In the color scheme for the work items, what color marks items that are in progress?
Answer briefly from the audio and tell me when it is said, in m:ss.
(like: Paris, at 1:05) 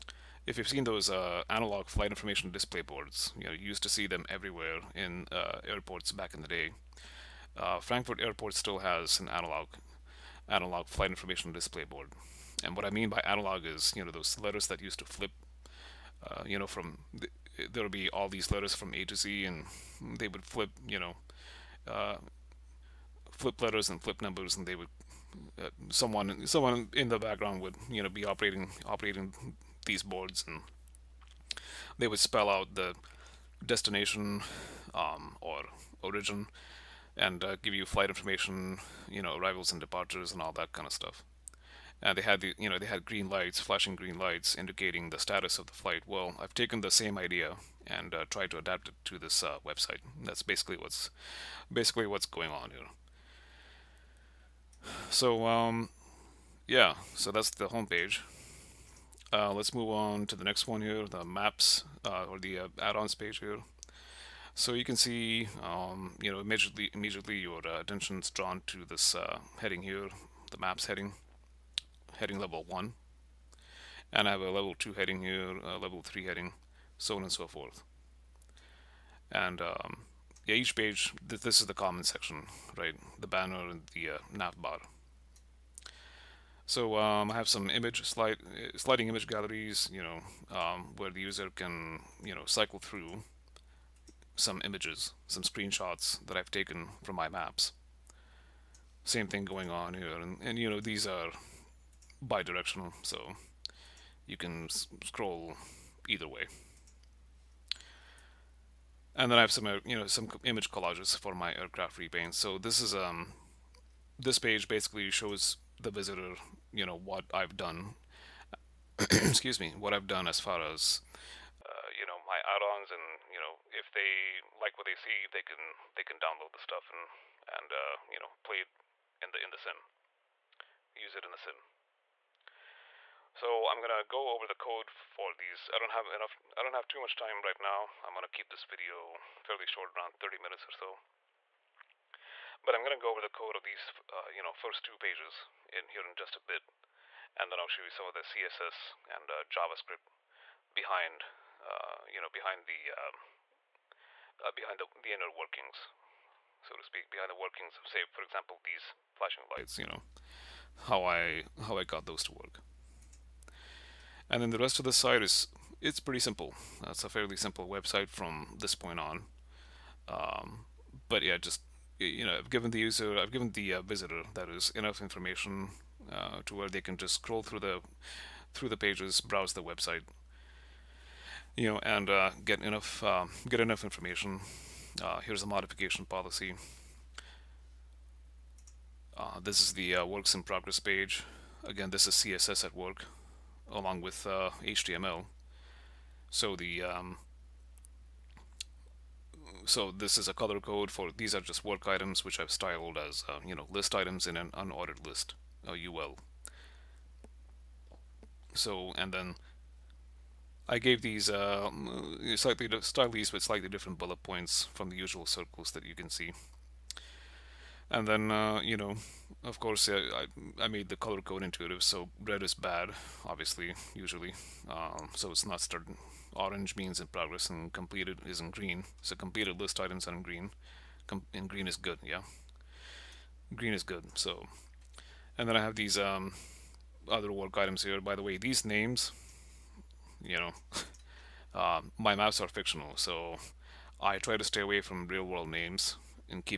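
Orange, at 3:46.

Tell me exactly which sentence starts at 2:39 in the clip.
You know, how I how I got those to work.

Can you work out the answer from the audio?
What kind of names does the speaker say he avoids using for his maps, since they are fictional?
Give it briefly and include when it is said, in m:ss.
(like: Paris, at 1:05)
Real world names, at 4:05.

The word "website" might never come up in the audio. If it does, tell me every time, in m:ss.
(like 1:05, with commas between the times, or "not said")
0:49, 2:47, 2:59.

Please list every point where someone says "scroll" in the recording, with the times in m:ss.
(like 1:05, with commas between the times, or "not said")
1:45, 2:57.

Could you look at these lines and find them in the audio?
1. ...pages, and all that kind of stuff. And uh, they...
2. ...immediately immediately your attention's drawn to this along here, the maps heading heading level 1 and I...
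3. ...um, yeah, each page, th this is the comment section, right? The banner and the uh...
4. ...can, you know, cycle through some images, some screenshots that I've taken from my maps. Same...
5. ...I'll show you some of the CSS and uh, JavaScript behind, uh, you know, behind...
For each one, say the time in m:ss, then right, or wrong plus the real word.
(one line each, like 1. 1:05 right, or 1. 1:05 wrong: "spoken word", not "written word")
1. 0:39 wrong: "departures", not "pages"
2. 1:06 wrong: "heading", not "along"
3. 1:19 right
4. 1:31 right
5. 2:27 right.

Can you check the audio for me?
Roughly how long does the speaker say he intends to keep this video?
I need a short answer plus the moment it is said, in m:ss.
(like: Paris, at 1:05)
30 minutes, at 2:20.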